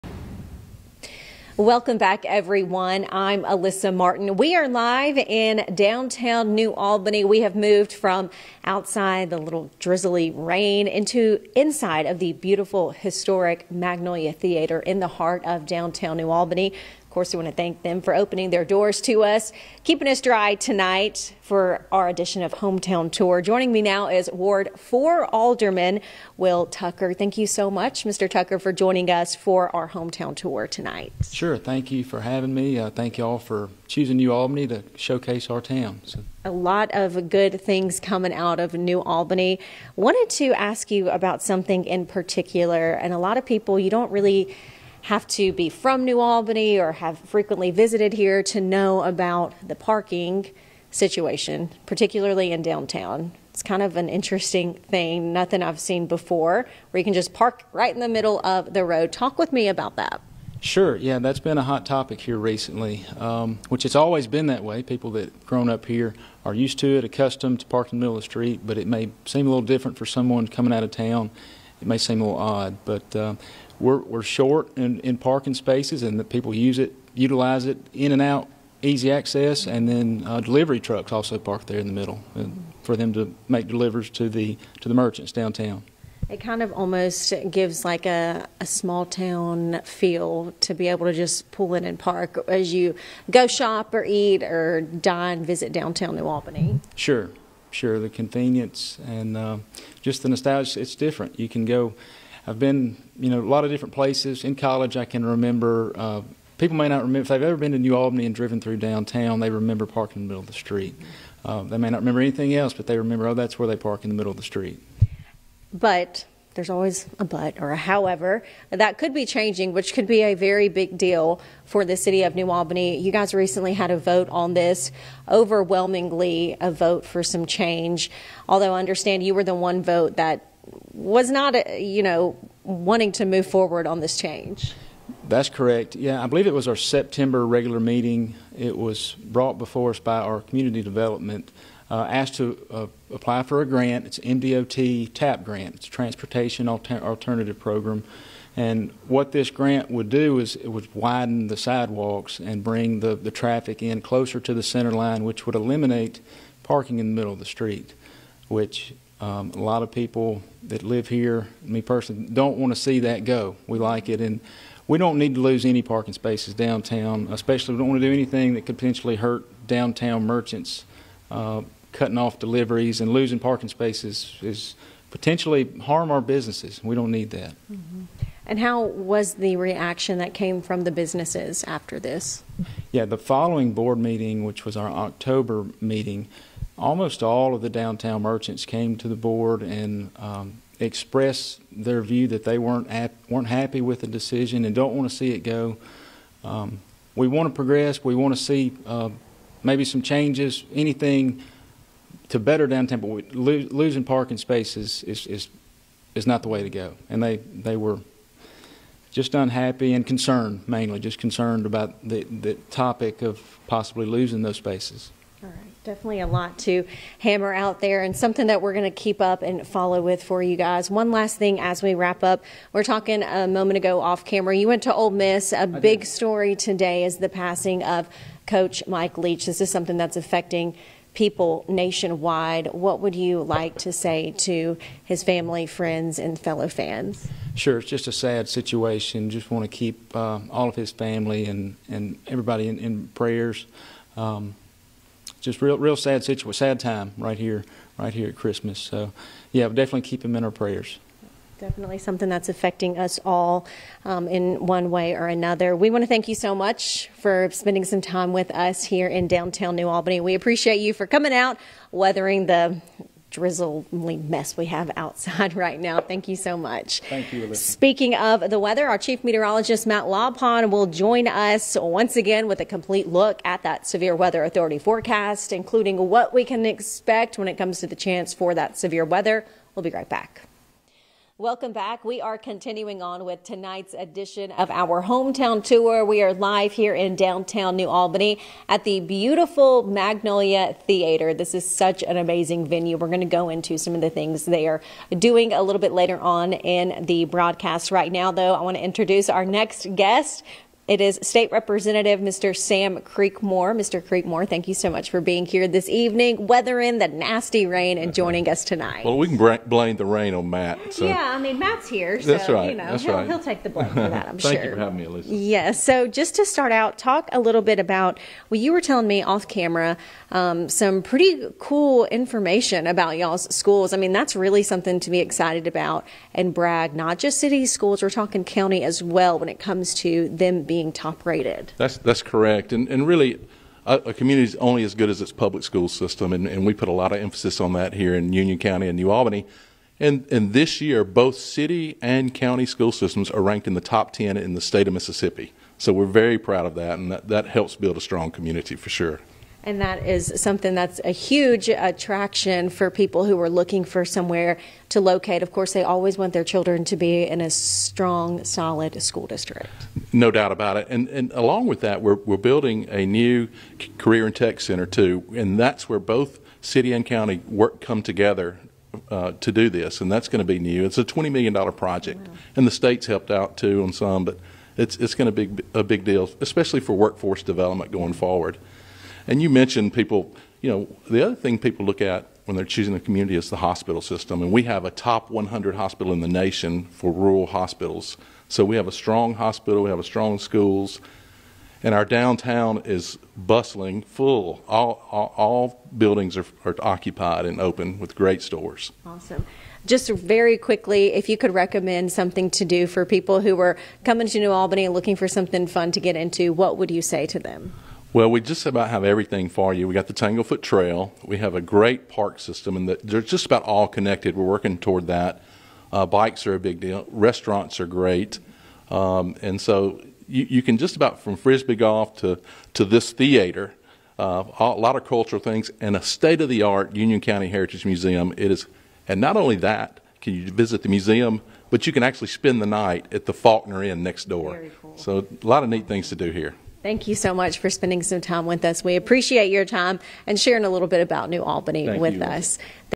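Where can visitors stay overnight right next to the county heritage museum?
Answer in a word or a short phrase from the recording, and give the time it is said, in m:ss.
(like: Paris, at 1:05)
Faulkner Inn, at 7:13.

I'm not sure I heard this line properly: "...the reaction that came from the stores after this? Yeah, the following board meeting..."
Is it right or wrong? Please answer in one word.
wrong.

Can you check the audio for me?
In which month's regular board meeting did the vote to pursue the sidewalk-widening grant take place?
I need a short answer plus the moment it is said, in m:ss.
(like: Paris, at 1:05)
September, at 2:16.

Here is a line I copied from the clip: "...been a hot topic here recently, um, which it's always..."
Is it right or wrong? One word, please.
right.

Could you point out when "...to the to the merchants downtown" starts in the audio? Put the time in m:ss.
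1:24.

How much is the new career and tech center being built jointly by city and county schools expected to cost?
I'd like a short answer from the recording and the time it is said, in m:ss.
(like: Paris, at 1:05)
$20 million, at 6:11.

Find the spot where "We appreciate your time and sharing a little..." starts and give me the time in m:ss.
7:18.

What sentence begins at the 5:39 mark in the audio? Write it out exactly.
And, and this year, both city and county school systems are ranked in the top 10 in the state of Mississippi.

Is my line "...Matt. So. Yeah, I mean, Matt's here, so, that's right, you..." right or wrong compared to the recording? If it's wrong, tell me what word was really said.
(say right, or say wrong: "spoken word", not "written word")
right.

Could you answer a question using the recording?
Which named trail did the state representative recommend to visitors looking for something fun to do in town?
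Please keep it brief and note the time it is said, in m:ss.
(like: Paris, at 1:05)
Tanglefoot Trail, at 6:50.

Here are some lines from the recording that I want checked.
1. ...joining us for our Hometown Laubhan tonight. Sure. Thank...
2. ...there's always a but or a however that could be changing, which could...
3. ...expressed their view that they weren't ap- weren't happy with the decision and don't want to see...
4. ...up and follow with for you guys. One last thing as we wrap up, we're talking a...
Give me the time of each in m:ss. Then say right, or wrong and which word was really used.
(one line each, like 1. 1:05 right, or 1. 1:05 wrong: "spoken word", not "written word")
1. 0:28 wrong: "Tour", not "Laubhan"
2. 1:56 right
3. 3:10 right
4. 3:39 right.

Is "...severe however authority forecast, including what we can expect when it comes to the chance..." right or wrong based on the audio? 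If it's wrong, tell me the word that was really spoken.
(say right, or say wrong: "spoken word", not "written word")
wrong: "weather", not "however".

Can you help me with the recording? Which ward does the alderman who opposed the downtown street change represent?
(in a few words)
Ward 4.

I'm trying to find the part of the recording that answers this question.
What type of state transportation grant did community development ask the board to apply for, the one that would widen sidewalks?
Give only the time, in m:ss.
2:24.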